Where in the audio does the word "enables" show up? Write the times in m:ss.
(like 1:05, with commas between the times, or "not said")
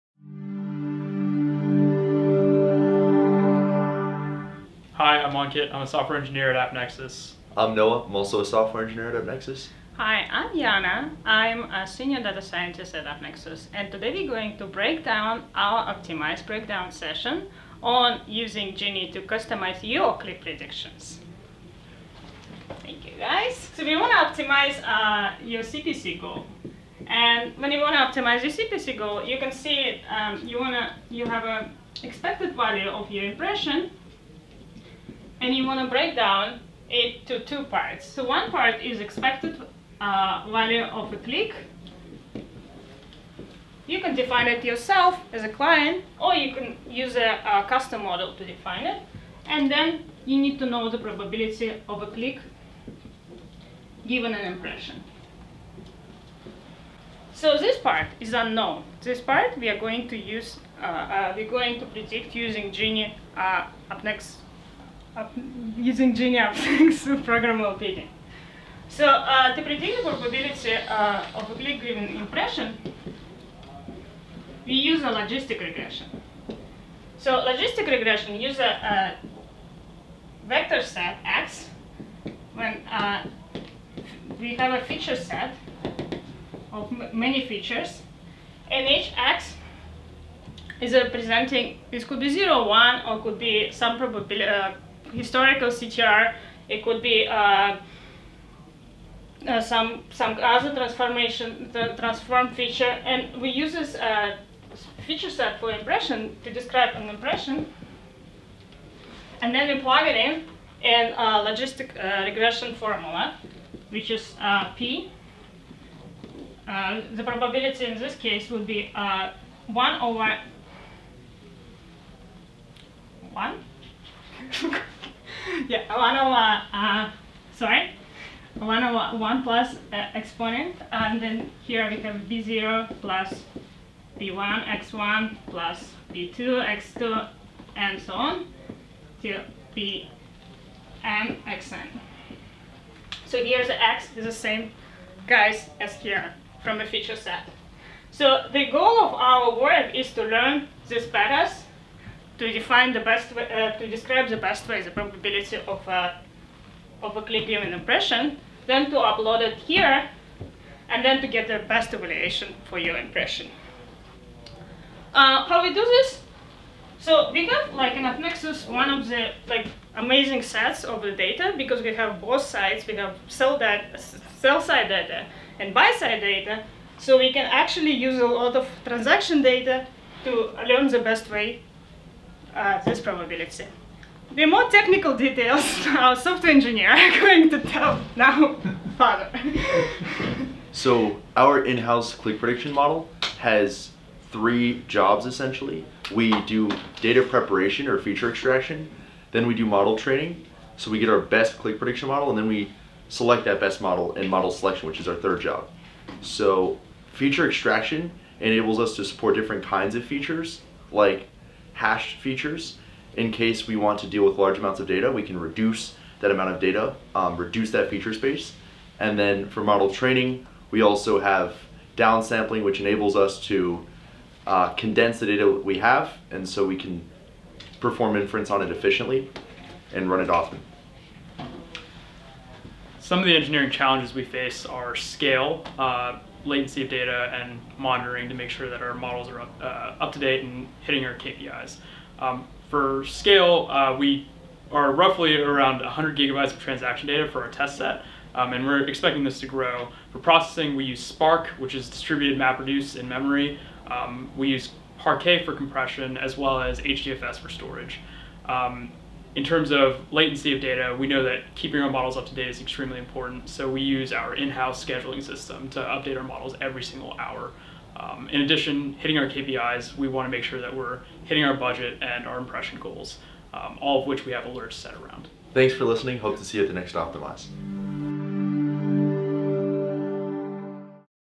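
3:28, 3:42.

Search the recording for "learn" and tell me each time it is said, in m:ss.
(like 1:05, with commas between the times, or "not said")
2:30, 3:00.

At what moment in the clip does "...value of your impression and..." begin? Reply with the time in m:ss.
0:32.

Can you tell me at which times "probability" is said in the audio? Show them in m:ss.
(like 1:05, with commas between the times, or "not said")
0:50, 1:10, 1:33, 1:57, 2:34, 3:02.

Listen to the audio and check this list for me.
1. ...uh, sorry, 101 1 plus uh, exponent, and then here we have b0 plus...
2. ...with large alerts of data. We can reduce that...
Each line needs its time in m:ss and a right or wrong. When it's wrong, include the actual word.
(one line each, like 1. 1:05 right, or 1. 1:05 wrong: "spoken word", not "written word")
1. 2:06 right
2. 3:34 wrong: "amounts", not "alerts".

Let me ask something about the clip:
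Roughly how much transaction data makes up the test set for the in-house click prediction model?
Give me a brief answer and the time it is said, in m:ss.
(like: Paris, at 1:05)
100 gigabytes, at 4:05.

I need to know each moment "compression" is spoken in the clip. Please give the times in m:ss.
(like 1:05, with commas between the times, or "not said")
4:15.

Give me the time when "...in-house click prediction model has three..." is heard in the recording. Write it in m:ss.
3:11.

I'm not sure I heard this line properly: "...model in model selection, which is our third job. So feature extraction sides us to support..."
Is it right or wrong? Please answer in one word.
wrong.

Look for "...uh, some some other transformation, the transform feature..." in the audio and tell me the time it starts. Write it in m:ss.
1:39.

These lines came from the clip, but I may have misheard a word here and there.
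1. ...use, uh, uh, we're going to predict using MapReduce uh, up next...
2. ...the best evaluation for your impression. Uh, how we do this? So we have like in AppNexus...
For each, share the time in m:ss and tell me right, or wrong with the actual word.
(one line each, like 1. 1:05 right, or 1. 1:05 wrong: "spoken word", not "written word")
1. 1:00 wrong: "Genie", not "MapReduce"
2. 2:41 right.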